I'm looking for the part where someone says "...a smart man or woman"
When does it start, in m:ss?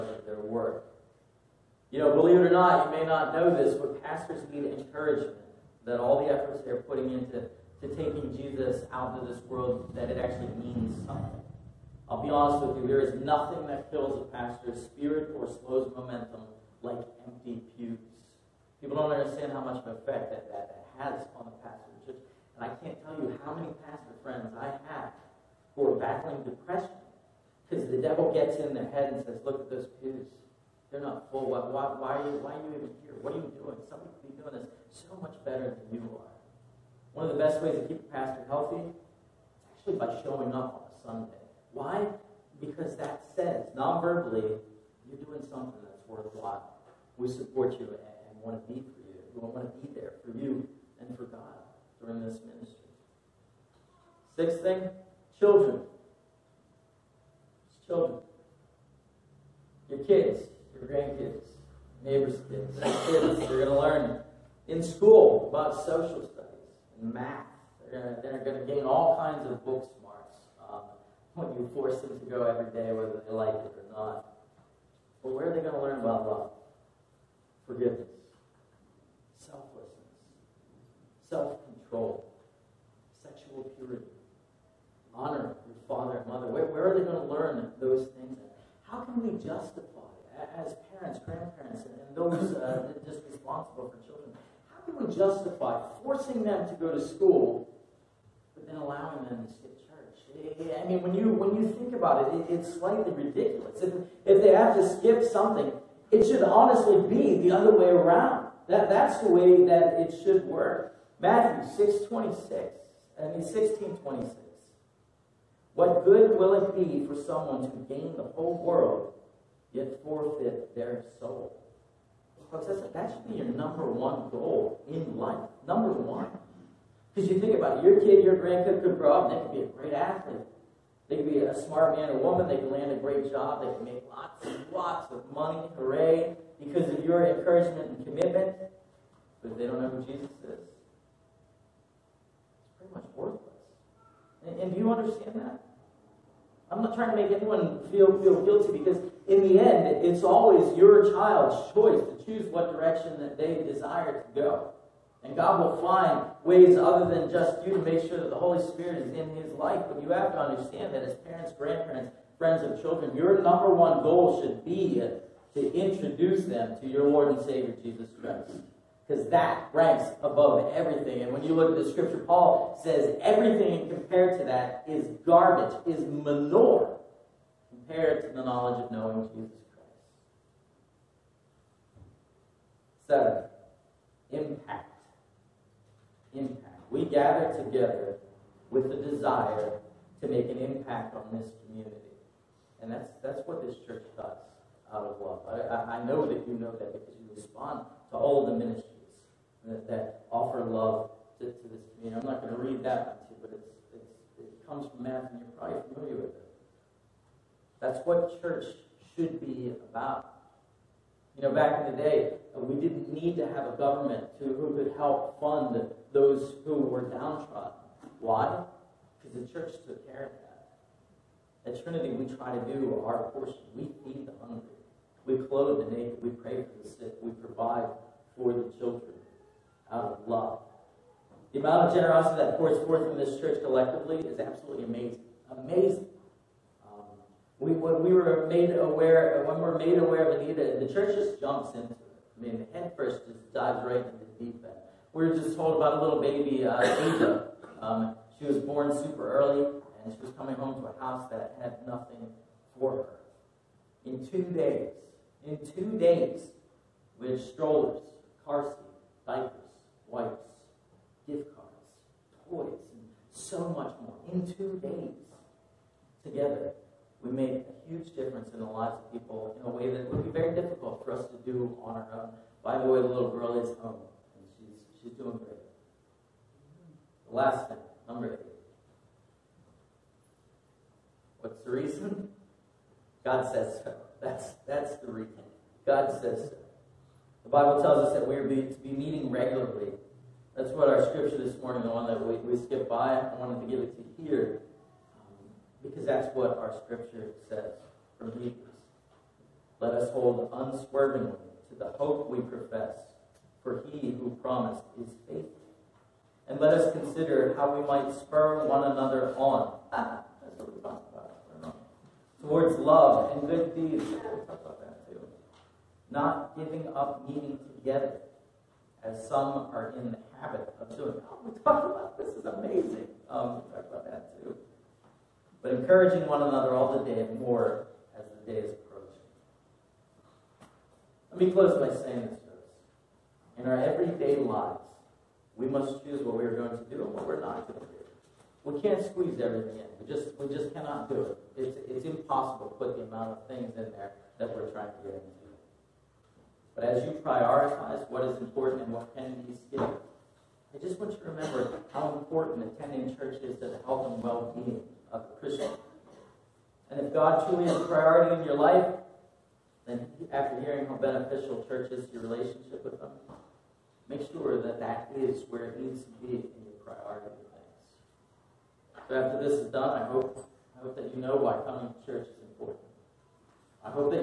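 2:11.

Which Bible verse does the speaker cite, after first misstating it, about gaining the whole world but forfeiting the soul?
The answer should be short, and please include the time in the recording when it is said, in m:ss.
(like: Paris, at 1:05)
Matthew 16:26, at 1:53.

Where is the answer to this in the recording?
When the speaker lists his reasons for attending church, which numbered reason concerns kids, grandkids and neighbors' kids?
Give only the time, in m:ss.
0:54.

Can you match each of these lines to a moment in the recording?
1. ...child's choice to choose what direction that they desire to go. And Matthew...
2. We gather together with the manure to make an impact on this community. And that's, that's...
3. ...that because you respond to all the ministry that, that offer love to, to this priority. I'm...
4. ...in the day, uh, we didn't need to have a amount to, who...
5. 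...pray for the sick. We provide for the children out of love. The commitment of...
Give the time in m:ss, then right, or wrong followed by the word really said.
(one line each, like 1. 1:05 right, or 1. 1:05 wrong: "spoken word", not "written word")
1. 2:31 wrong: "God", not "Matthew"
2. 3:06 wrong: "desire", not "manure"
3. 3:16 wrong: "community", not "priority"
4. 3:31 wrong: "government", not "amount"
5. 3:46 wrong: "amount", not "commitment".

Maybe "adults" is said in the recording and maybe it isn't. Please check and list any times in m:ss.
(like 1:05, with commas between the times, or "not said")
not said.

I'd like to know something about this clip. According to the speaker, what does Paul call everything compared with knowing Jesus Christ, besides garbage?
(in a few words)
Manure.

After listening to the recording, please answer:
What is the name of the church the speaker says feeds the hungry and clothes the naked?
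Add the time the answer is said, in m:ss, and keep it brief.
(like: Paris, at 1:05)
Trinity, at 3:41.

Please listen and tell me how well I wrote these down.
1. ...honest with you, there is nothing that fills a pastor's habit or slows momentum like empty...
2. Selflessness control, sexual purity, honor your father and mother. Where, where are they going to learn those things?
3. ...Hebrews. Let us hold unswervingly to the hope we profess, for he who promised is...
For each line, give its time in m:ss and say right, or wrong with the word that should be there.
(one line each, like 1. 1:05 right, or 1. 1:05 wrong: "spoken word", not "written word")
1. 0:12 wrong: "spirit", not "habit"
2. 1:21 right
3. 4:58 right.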